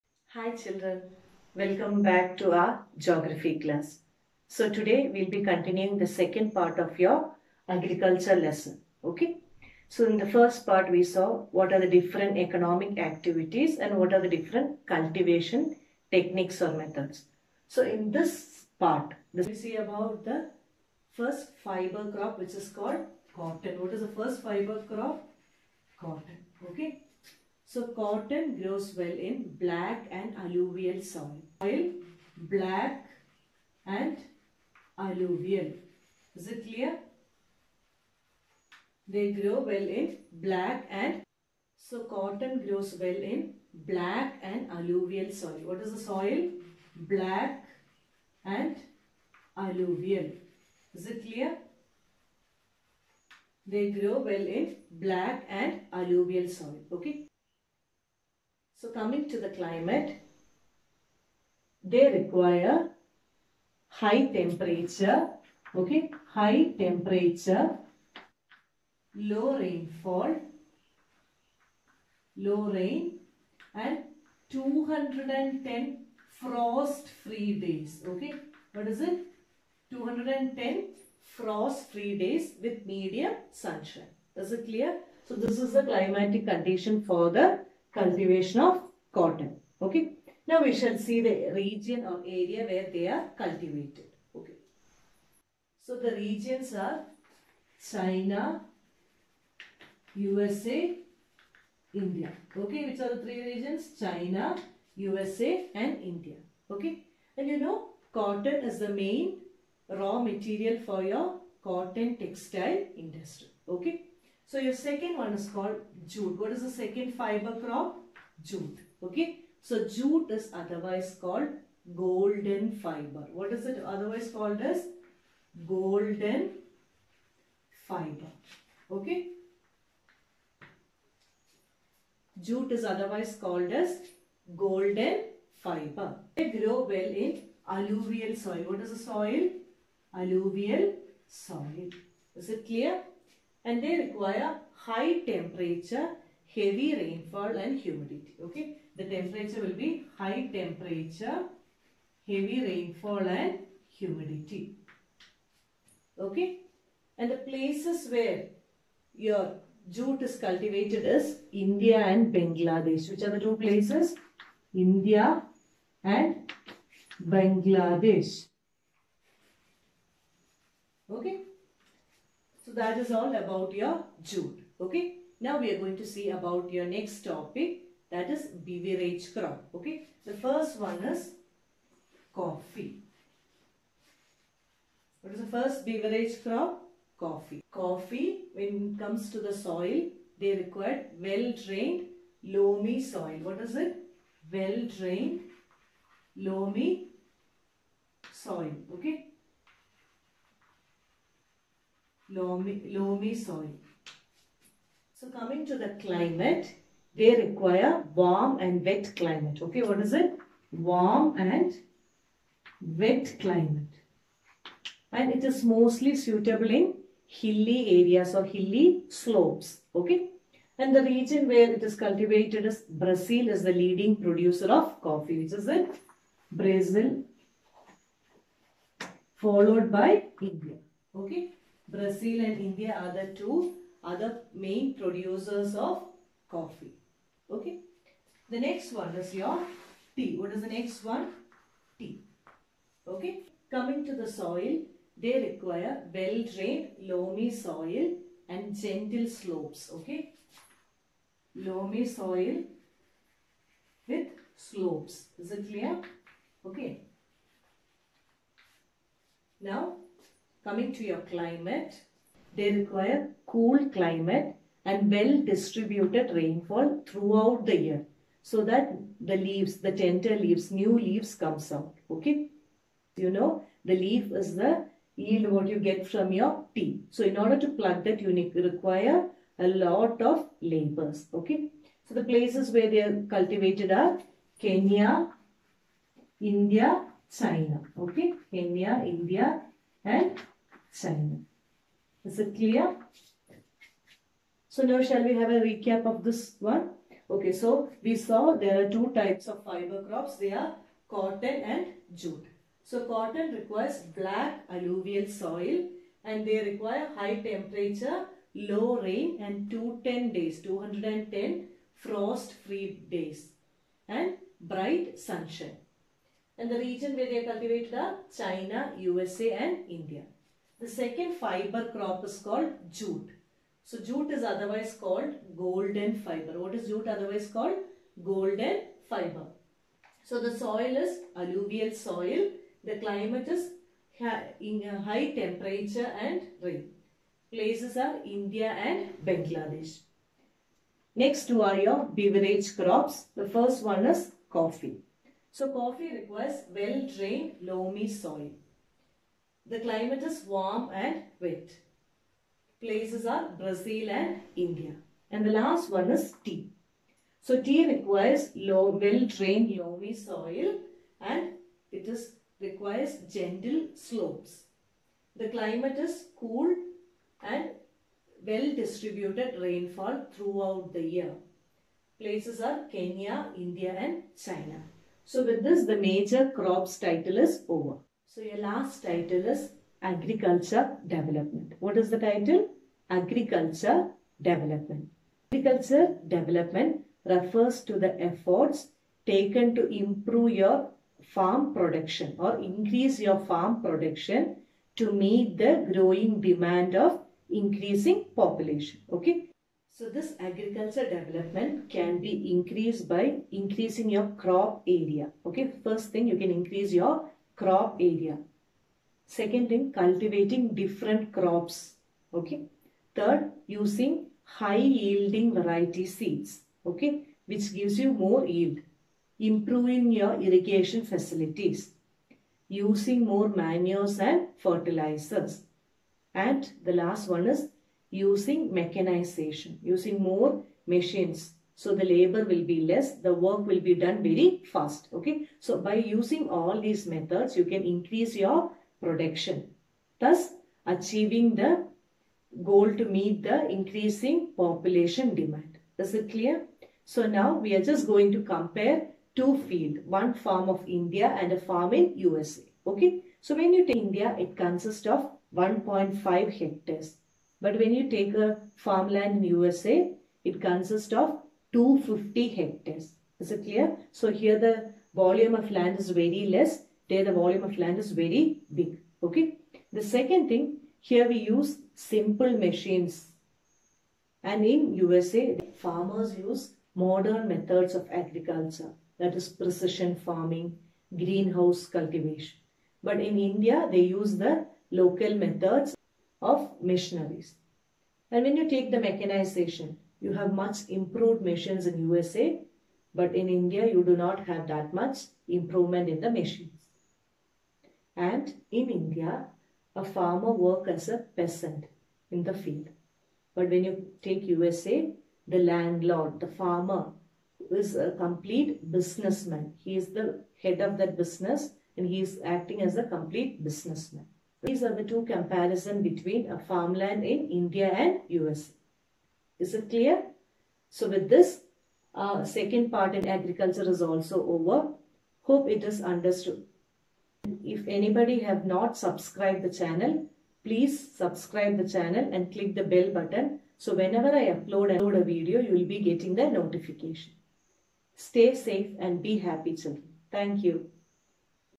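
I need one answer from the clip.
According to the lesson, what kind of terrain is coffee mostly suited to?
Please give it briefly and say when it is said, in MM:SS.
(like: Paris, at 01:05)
Hilly slopes, at 03:38.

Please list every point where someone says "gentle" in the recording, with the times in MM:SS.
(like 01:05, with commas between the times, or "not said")
04:08, 06:03.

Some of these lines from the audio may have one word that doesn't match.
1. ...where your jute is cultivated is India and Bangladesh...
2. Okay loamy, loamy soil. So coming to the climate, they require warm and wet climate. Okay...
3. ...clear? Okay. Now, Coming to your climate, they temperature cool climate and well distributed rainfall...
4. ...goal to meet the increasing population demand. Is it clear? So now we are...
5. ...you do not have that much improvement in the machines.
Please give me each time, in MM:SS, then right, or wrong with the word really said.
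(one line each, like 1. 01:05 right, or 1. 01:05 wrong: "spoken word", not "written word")
1. 02:38 right
2. 03:18 right
3. 04:15 wrong: "require", not "temperature"
4. 07:22 right
5. 08:13 right.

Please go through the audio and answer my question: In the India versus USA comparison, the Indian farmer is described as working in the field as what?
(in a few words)
A peasant.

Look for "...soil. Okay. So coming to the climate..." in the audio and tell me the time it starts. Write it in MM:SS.
00:56.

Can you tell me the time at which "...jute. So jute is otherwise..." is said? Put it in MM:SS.
05:22.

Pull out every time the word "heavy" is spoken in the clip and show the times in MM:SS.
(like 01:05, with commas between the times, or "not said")
02:26, 02:32.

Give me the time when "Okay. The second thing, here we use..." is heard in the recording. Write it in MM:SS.
07:49.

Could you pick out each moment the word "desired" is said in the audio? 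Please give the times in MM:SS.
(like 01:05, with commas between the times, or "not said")
not said.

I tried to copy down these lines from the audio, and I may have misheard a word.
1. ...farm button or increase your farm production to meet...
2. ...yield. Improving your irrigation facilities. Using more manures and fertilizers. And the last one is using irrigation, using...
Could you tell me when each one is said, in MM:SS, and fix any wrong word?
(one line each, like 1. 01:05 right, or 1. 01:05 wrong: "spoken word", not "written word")
1. 06:31 wrong: "production", not "button"
2. 06:58 wrong: "mechanization", not "irrigation".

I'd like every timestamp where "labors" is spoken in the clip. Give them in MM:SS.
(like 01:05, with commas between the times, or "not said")
04:40, 07:12.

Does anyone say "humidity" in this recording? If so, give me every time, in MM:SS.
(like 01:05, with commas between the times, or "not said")
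02:27, 02:33.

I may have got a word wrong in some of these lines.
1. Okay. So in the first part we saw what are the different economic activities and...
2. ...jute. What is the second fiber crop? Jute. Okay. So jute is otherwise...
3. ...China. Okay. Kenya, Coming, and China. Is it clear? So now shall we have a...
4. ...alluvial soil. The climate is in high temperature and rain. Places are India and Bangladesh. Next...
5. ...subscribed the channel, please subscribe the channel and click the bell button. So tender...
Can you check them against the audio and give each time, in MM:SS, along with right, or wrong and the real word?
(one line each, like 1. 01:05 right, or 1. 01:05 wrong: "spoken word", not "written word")
1. 00:09 right
2. 01:56 right
3. 04:47 wrong: "India", not "Coming"
4. 05:31 right
5. 08:48 wrong: "whenever", not "tender".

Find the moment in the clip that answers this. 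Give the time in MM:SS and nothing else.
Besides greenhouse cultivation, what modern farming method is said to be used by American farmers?
07:59.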